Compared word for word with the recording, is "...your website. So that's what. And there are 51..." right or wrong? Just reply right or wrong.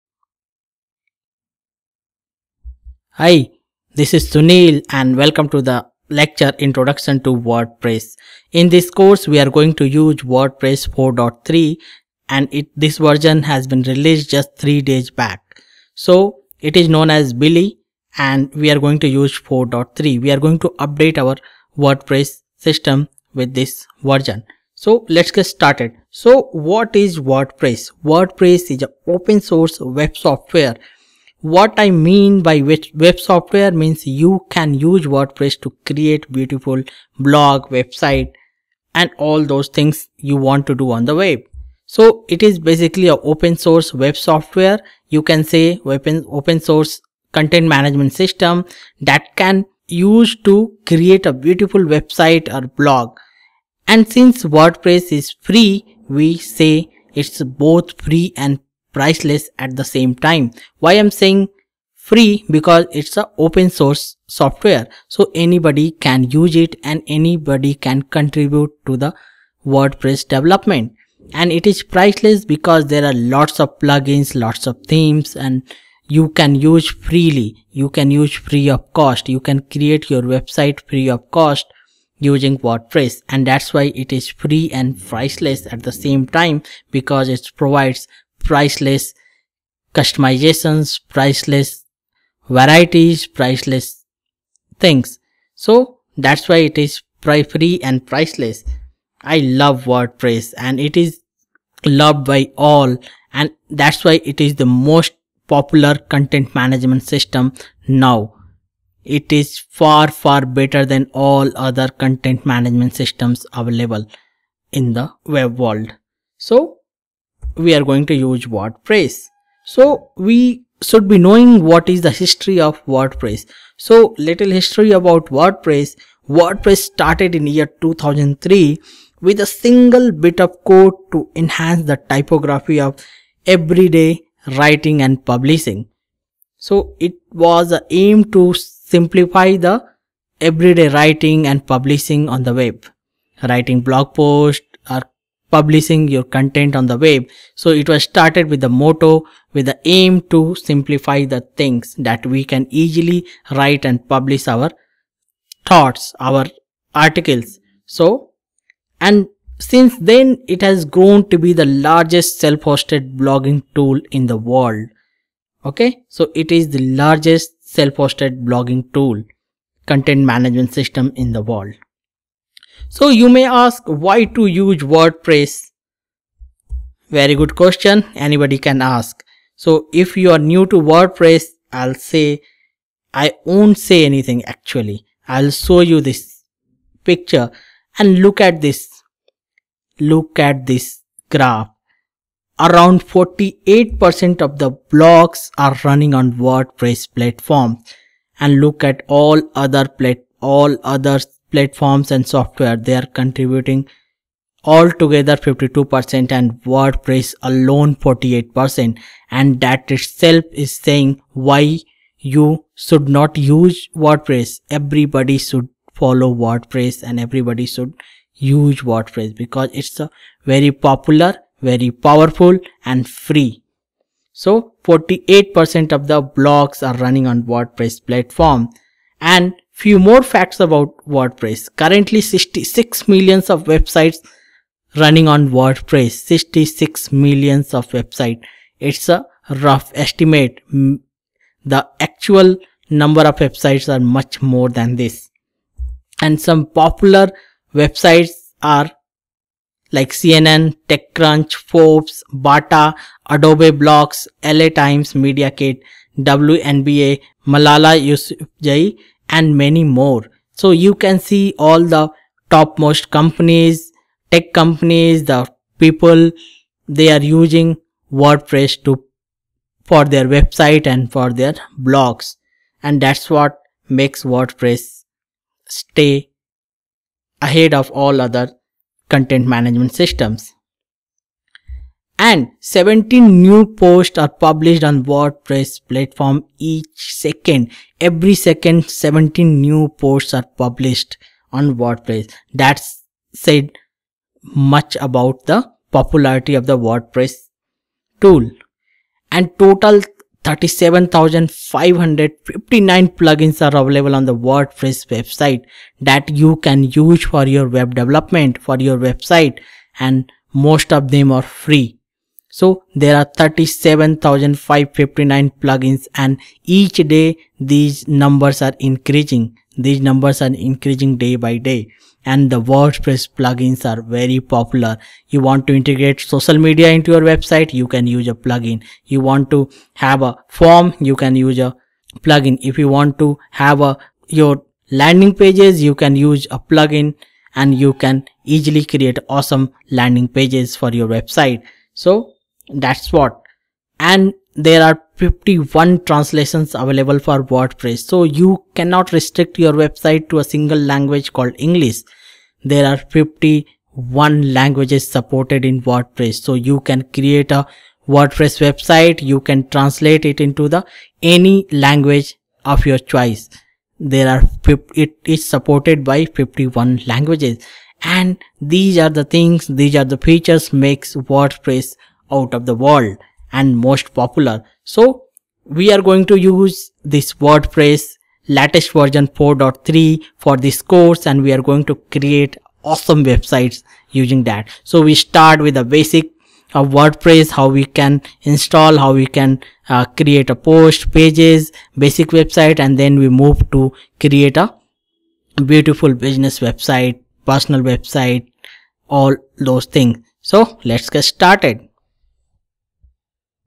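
right.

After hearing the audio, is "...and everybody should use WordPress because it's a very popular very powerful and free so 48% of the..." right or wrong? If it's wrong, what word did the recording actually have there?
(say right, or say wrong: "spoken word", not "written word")
right.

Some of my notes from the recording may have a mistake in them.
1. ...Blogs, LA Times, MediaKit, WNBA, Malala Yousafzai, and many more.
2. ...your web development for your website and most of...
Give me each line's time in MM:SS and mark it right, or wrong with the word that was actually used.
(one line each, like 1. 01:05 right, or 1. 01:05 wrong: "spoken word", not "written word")
1. 04:13 right
2. 05:07 right.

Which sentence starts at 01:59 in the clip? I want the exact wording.
So we should be knowing what is the history of WordPress.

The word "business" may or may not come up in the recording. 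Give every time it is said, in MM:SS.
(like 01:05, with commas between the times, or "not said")
06:36.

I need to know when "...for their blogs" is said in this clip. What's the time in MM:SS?
04:31.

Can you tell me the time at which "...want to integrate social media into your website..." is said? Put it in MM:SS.
05:25.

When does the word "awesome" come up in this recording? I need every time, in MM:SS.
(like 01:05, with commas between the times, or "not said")
05:39, 06:22.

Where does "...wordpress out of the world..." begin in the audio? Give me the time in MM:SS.
06:11.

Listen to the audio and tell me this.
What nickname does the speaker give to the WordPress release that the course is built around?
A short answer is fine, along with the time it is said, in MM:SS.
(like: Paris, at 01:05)
Billie, at 00:17.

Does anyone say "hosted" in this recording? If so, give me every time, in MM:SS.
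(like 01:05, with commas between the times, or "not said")
02:42, 02:47.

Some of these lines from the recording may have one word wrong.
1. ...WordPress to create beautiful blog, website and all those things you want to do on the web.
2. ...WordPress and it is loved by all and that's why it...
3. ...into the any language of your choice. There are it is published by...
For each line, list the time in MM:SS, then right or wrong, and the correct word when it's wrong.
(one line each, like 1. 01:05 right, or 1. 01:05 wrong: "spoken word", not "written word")
1. 00:35 right
2. 01:39 right
3. 06:00 wrong: "supported", not "published".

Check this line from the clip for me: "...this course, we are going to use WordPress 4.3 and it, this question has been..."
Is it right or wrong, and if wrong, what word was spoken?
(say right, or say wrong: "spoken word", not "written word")
wrong: "version", not "question".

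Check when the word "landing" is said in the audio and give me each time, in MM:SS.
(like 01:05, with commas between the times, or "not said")
05:34, 05:39.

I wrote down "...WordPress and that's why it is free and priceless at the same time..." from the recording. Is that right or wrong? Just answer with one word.
right.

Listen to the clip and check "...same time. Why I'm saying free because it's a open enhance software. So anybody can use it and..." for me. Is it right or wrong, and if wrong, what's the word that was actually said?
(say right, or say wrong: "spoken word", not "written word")
wrong: "source", not "enhance".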